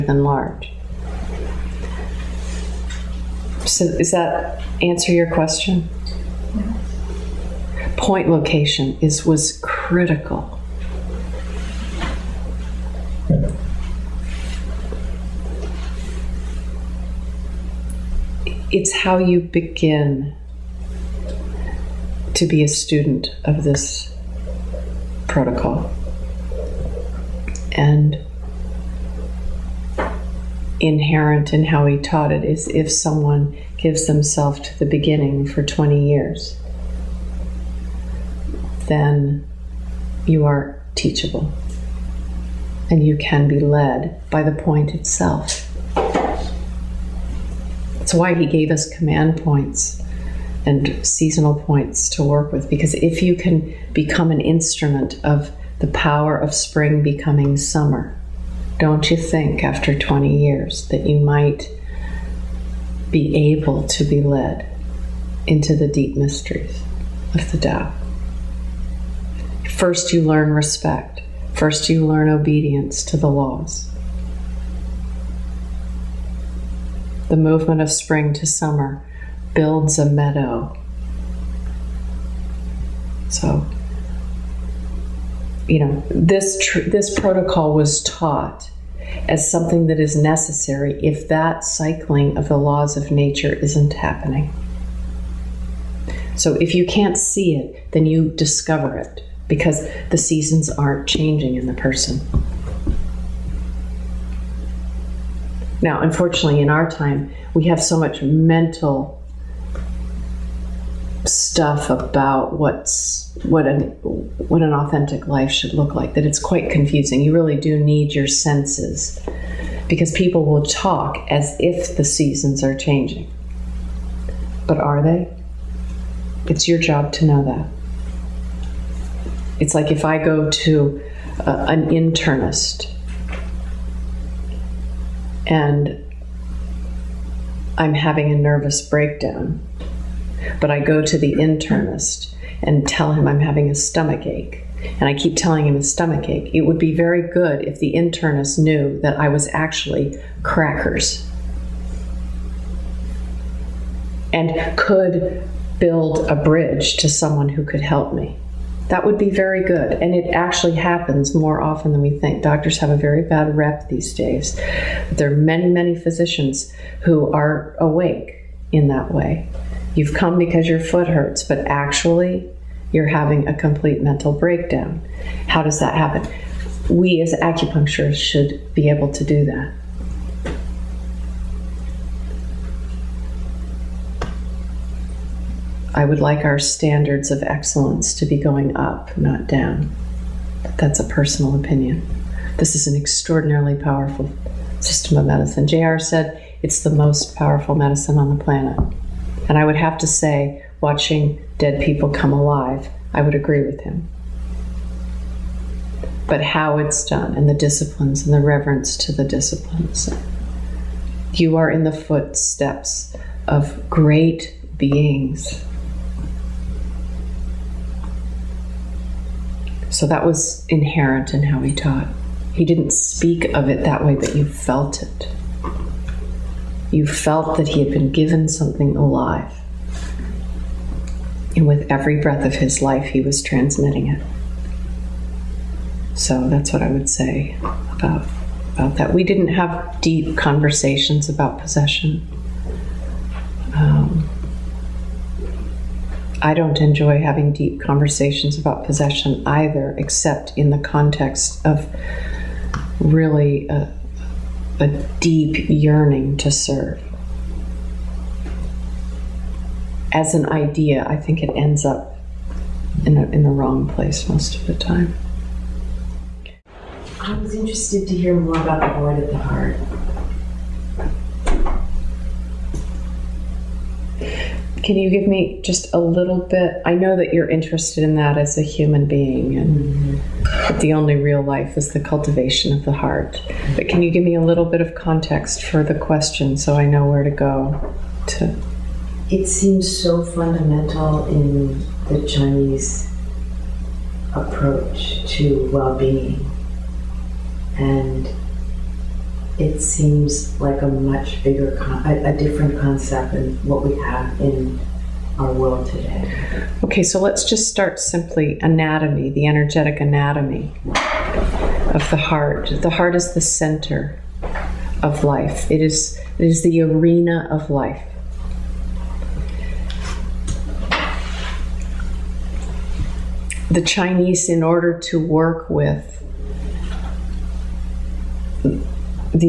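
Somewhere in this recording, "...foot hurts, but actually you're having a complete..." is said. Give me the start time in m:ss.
2:50.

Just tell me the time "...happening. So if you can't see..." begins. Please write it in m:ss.
1:33.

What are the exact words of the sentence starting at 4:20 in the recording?
As an idea, I think it ends up in, a, in the wrong place most of the time.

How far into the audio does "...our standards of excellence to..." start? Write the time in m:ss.
3:06.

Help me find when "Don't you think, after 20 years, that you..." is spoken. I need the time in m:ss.
0:58.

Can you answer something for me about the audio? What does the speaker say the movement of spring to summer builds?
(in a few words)
a meadow.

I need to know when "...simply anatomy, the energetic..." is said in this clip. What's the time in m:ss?
5:07.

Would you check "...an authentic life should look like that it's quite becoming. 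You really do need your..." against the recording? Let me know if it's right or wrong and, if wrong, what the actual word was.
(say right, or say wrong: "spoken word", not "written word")
wrong: "confusing", not "becoming".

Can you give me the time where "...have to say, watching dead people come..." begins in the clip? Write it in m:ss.
3:19.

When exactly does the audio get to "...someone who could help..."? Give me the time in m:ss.
2:37.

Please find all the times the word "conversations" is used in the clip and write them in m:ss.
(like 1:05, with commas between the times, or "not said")
4:00, 4:07.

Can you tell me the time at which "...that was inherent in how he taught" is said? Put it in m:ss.
3:40.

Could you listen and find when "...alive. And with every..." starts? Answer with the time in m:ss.
3:48.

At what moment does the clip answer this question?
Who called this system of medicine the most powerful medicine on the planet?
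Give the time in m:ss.
3:15.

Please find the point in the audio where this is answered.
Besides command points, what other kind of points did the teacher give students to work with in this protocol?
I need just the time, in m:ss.
0:51.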